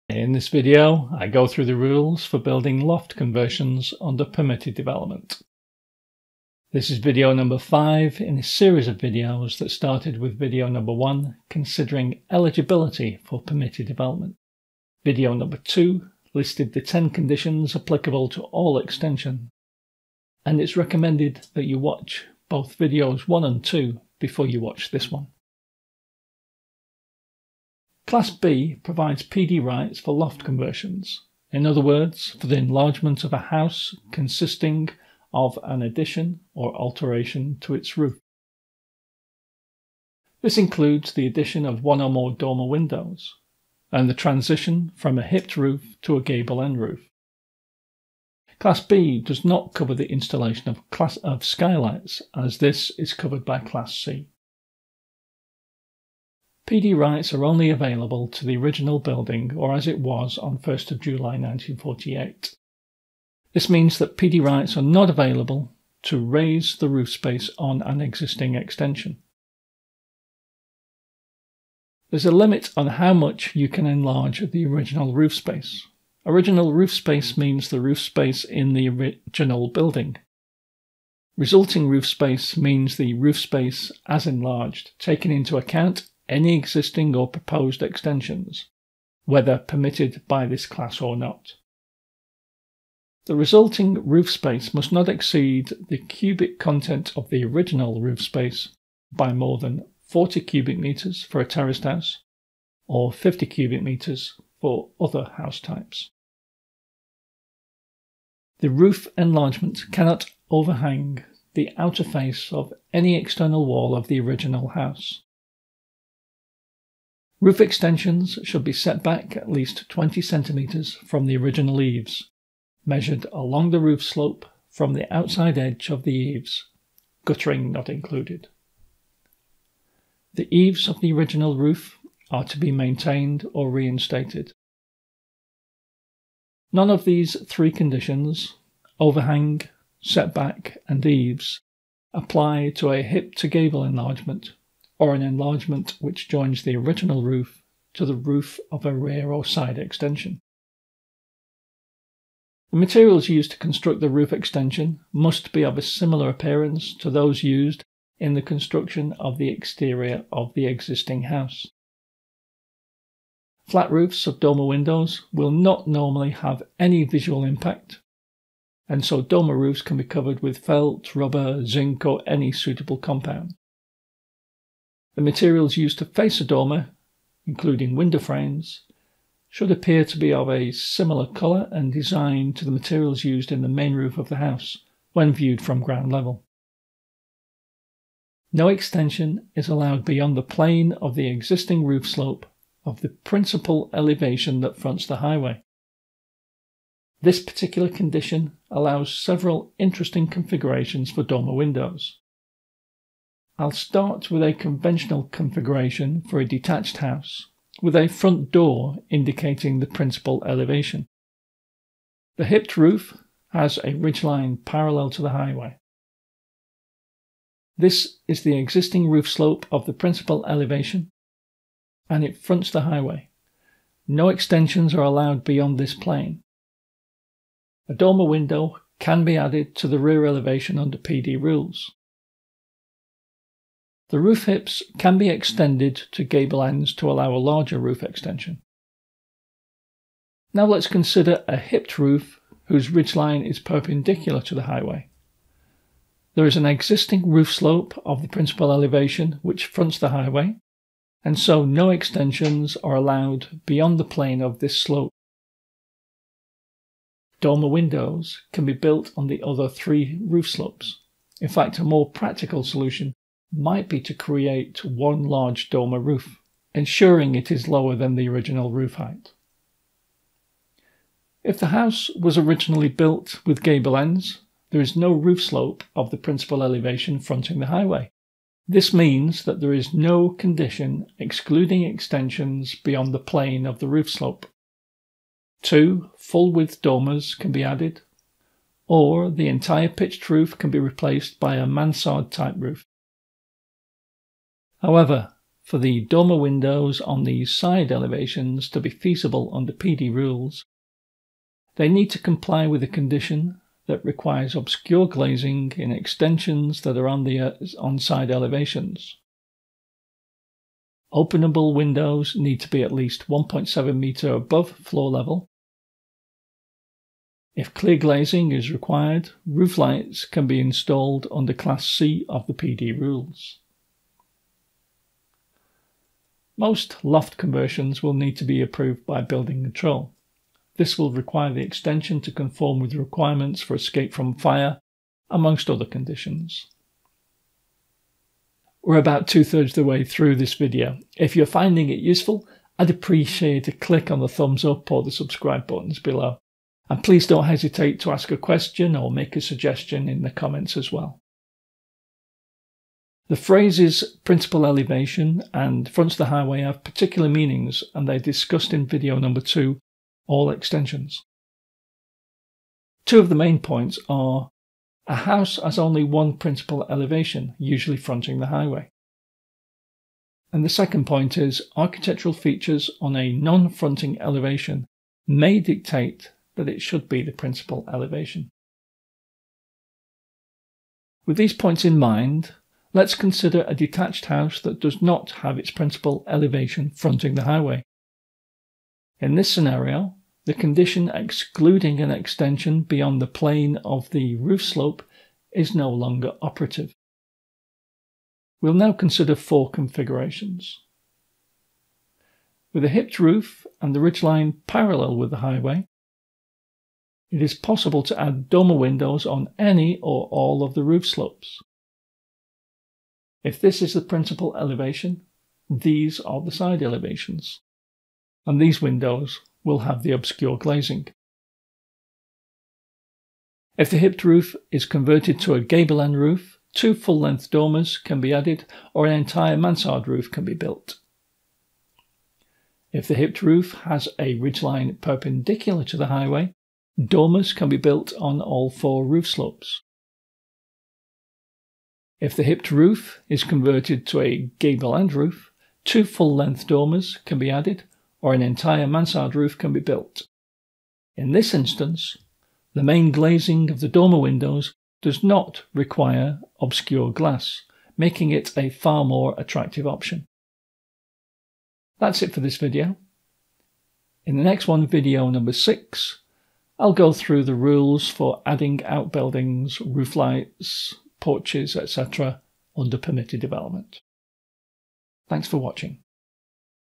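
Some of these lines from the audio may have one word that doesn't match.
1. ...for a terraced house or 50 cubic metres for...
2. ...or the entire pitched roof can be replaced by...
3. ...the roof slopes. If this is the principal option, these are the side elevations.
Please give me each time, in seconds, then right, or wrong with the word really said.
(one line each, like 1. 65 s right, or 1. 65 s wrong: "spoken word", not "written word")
1. 101 s right
2. 288 s right
3. 410 s wrong: "elevation", not "option".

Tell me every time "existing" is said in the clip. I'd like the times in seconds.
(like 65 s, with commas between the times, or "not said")
67 s, 86 s, 160 s, 191 s, 218 s, 246 s.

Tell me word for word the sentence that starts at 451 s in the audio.
In this instance, the main glazing of the dormer windows does not require obscure glass, making it a far more attractive option.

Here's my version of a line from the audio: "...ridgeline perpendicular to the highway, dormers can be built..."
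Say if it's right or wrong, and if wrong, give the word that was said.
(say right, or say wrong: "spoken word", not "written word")
right.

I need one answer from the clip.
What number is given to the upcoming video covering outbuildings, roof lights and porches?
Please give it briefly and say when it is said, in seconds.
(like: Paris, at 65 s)
6, at 465 s.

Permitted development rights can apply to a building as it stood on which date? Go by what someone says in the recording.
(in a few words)
1st of July 1948.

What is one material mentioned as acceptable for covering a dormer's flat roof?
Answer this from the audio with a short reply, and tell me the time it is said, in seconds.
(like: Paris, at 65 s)
Zinc, at 171 s.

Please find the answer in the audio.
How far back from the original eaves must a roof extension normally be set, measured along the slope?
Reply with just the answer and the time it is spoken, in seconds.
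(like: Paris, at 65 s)
20 centimetres, at 119 s.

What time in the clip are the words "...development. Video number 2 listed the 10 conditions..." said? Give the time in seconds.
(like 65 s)
13 s.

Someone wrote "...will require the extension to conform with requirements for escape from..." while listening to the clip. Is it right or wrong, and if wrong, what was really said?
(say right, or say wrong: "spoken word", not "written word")
right.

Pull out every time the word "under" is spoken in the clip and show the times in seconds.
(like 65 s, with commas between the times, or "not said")
4 s, 230 s, 299 s, 321 s, 472 s.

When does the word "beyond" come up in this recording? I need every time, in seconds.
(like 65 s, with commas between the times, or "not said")
190 s, 225 s, 253 s, 282 s, 392 s.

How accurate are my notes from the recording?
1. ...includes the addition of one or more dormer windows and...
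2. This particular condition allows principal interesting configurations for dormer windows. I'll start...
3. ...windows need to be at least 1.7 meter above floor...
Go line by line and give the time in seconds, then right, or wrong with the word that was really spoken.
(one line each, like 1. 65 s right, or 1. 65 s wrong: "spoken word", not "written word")
1. 40 s right
2. 197 s wrong: "several", not "principal"
3. 311 s right.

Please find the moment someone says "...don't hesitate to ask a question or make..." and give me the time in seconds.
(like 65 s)
347 s.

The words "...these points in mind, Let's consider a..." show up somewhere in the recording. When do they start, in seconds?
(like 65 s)
381 s.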